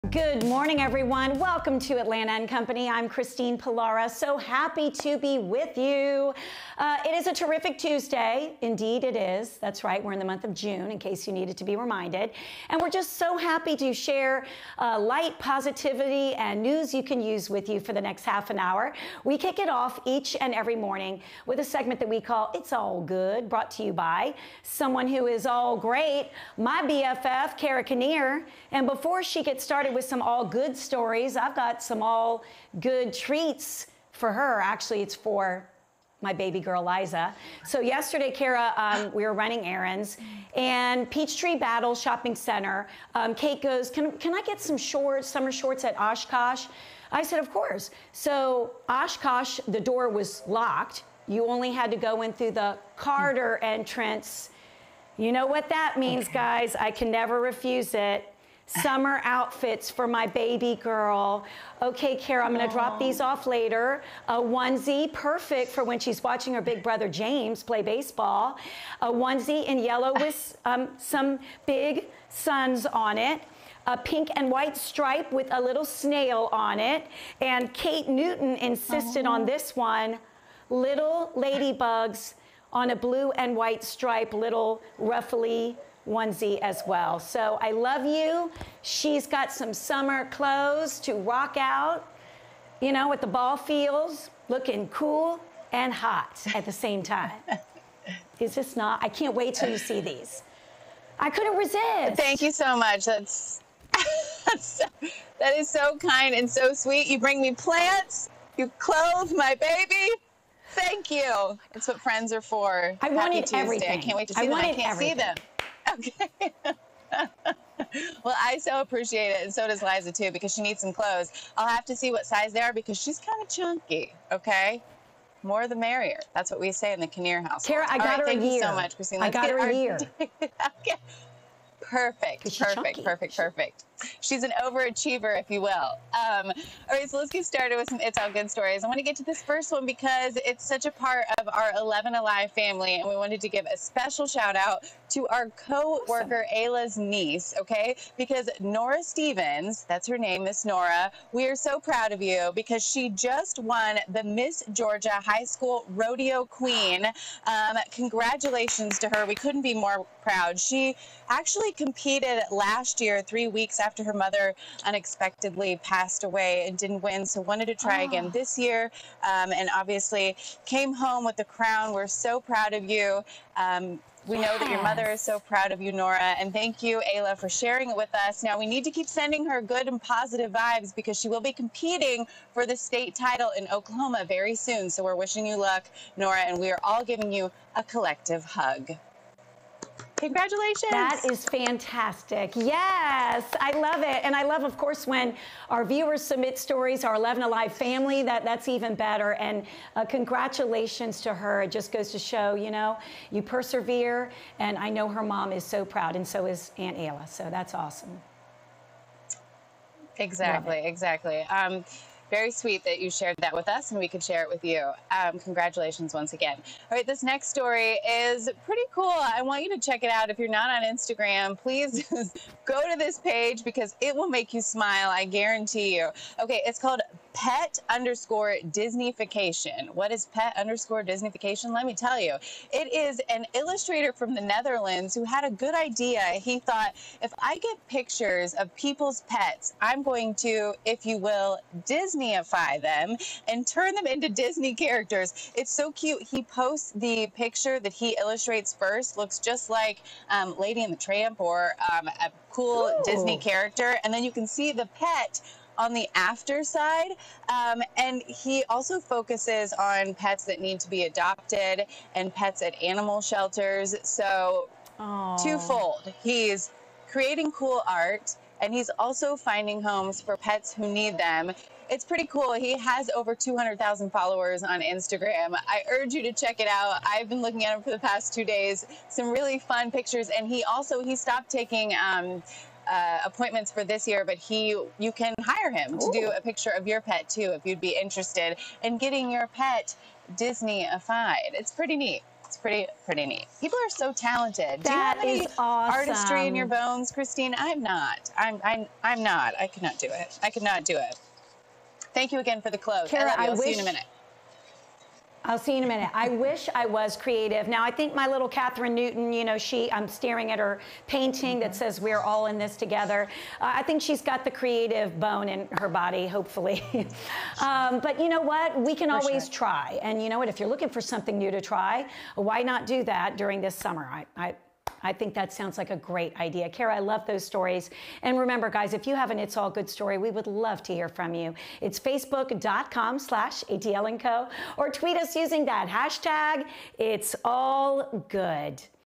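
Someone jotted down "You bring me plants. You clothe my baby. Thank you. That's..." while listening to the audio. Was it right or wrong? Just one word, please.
right.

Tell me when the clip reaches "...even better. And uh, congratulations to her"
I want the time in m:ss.
3:18.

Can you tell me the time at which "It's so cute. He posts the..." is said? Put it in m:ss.
4:05.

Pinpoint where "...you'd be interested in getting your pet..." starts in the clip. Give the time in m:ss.
4:47.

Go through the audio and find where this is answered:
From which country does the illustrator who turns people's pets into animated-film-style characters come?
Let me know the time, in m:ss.
3:54.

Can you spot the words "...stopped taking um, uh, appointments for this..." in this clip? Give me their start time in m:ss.
4:41.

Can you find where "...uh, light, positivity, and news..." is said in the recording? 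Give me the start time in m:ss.
0:14.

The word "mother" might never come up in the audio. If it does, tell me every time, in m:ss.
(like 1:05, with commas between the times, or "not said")
2:44, 2:54.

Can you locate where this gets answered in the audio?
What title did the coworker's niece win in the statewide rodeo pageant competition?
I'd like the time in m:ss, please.
2:34.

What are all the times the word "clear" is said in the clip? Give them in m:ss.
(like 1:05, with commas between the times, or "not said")
not said.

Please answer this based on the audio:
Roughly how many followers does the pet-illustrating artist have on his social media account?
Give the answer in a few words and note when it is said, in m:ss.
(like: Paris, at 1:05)
200,000, at 4:33.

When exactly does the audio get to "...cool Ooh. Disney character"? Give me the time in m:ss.
4:12.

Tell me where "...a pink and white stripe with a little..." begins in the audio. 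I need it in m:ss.
1:13.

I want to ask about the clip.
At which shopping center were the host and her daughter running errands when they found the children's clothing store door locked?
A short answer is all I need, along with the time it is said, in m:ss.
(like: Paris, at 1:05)
Peachtree Battle, at 0:41.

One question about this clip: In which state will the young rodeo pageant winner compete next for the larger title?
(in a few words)
Oklahoma.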